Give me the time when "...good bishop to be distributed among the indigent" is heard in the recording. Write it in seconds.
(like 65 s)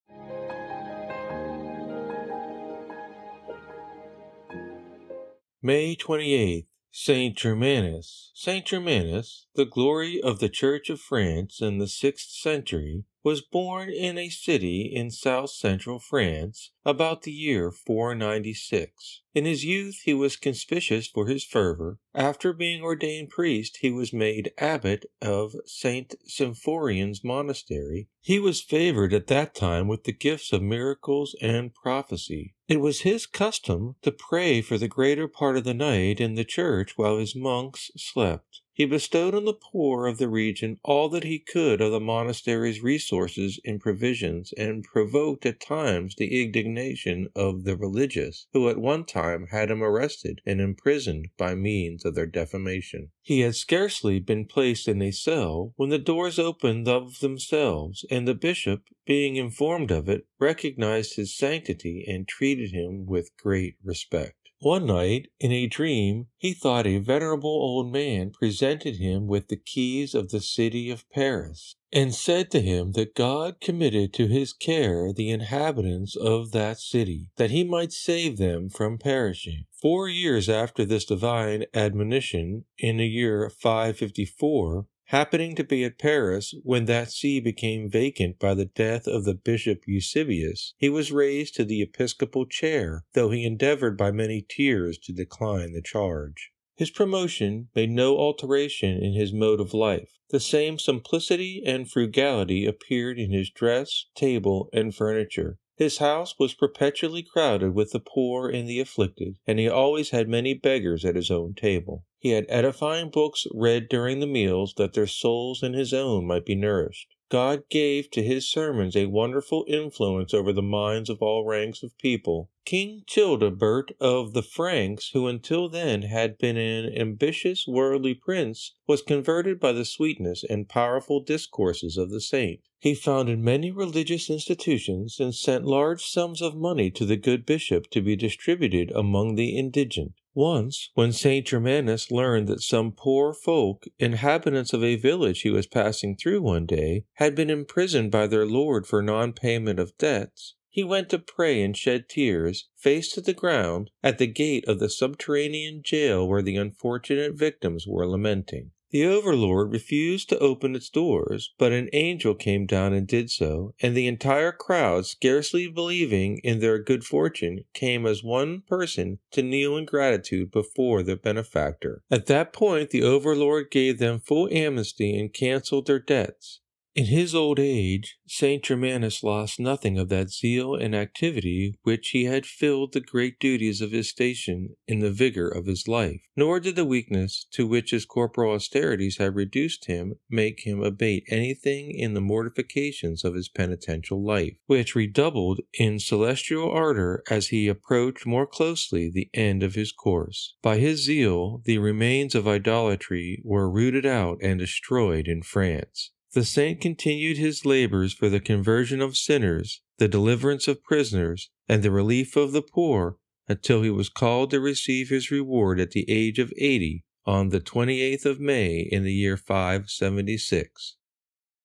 137 s.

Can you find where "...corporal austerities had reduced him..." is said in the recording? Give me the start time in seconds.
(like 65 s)
188 s.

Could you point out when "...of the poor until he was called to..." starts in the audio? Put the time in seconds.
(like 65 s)
212 s.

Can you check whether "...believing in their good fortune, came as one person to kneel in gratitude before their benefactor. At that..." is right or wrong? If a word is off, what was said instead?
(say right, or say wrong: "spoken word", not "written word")
right.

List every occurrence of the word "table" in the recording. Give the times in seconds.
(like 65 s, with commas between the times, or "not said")
104 s, 111 s.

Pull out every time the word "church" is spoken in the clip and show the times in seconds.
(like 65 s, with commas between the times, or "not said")
10 s, 36 s.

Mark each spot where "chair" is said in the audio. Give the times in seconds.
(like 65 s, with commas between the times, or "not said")
92 s.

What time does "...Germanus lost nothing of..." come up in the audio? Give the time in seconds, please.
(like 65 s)
178 s.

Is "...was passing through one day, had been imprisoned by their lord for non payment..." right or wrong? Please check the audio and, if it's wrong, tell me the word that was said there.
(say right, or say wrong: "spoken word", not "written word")
right.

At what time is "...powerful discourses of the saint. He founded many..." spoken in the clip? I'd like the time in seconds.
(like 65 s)
130 s.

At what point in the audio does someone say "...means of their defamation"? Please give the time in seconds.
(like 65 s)
51 s.